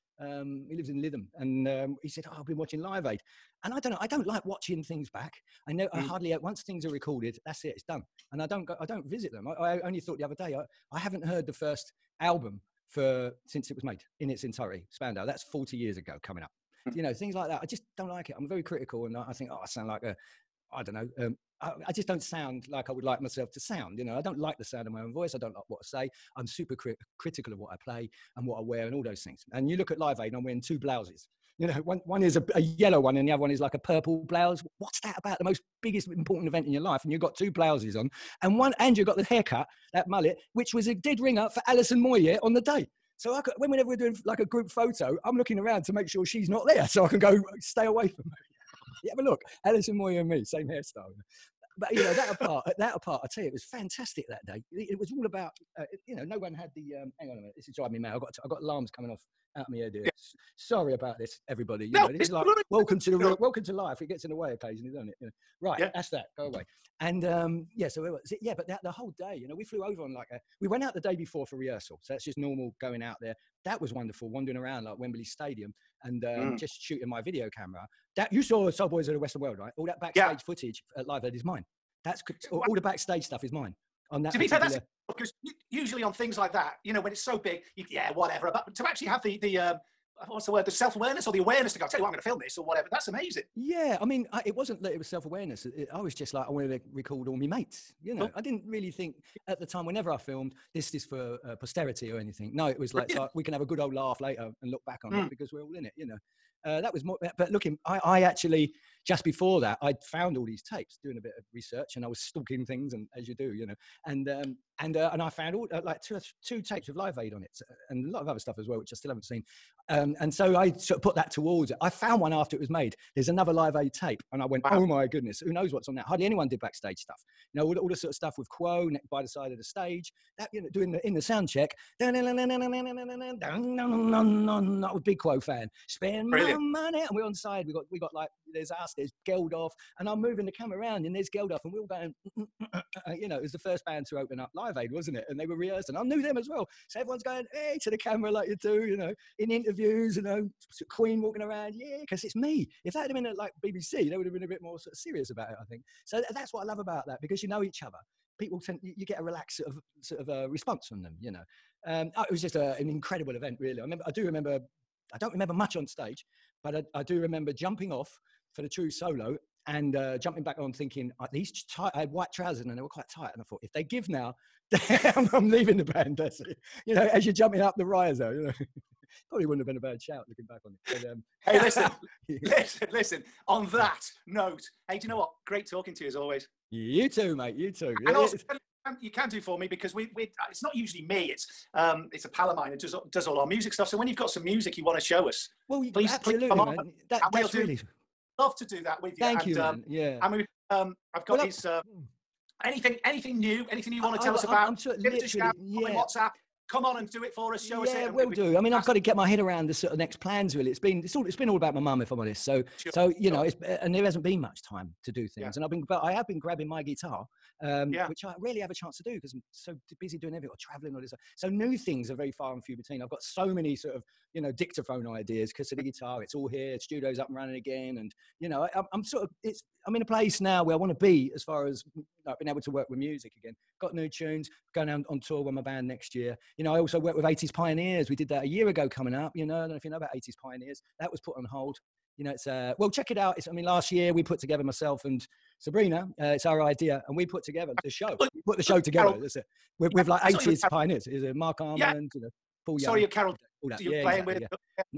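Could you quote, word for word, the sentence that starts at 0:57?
Um, hang on a minute, this is driving me mad.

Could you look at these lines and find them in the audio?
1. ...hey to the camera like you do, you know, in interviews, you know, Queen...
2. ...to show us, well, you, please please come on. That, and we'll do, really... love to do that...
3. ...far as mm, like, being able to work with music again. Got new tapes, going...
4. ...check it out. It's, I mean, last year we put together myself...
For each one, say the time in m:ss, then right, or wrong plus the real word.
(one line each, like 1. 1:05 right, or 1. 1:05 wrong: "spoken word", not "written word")
1. 2:27 right
2. 3:14 right
3. 3:51 wrong: "tunes", not "tapes"
4. 4:02 right.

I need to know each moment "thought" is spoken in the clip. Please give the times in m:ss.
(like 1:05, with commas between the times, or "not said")
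0:09, 2:53.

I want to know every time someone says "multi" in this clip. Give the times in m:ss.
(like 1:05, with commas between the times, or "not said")
not said.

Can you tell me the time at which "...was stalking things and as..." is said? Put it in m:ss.
1:52.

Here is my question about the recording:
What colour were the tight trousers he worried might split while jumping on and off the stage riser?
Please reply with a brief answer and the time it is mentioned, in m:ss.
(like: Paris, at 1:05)
White, at 2:52.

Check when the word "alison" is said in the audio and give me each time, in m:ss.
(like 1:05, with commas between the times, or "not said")
0:41, 0:49.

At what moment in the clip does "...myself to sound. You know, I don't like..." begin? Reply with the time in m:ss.
0:23.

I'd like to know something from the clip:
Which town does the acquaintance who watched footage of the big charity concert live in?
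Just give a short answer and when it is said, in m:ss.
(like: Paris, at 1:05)
Lytham, at 0:01.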